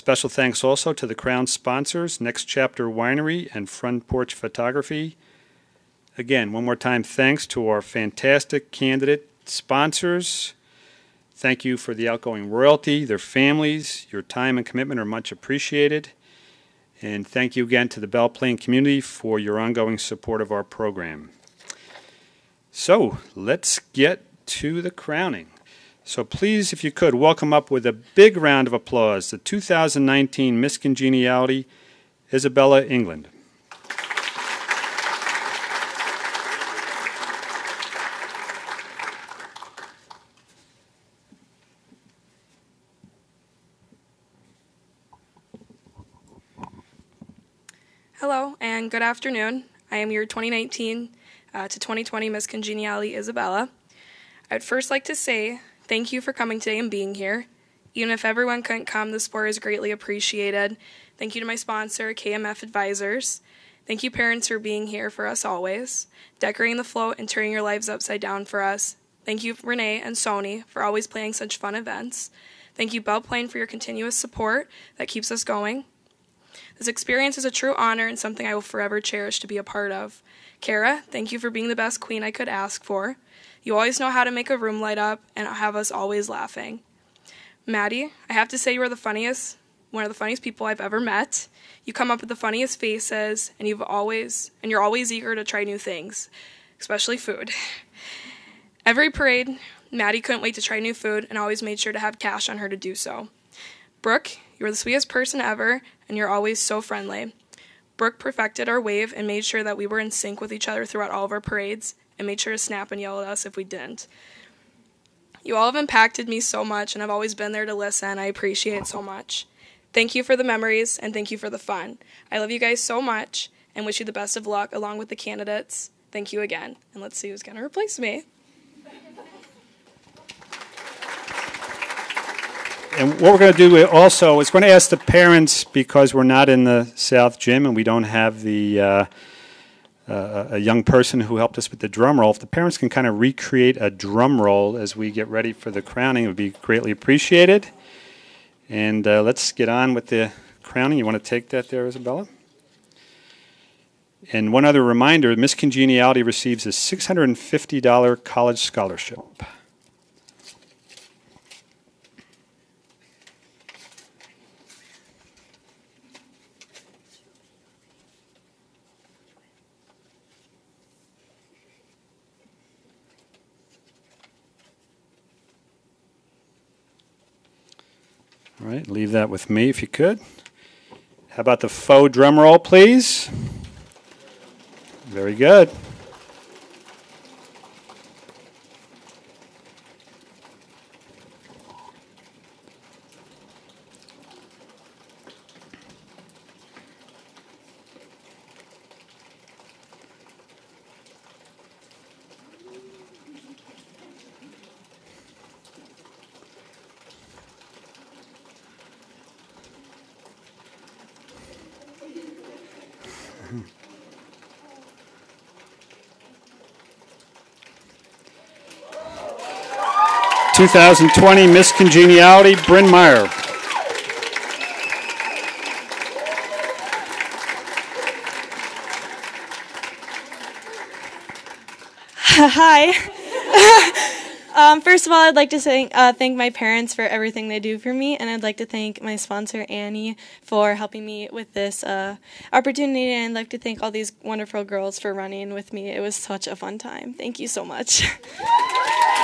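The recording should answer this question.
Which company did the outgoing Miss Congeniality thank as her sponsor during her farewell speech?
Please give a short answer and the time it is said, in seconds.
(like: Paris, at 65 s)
KMF Advisors, at 62 s.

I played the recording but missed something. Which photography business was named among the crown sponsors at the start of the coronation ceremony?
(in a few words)
Front Porch Photography.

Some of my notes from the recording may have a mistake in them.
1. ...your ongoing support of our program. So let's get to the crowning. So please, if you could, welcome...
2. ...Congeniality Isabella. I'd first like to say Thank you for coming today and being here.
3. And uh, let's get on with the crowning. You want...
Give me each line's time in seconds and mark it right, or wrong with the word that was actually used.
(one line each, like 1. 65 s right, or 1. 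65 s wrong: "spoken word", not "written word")
1. 19 s right
2. 52 s right
3. 148 s right.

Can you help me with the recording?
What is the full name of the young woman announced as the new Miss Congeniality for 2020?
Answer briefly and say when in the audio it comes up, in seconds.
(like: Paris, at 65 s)
Bryn Meyer, at 222 s.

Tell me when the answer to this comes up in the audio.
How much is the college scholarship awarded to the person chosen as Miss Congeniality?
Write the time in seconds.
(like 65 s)
156 s.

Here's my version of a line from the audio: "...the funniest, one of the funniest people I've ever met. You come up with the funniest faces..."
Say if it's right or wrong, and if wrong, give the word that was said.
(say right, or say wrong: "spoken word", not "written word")
right.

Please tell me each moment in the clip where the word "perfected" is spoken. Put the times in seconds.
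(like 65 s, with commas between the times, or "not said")
108 s.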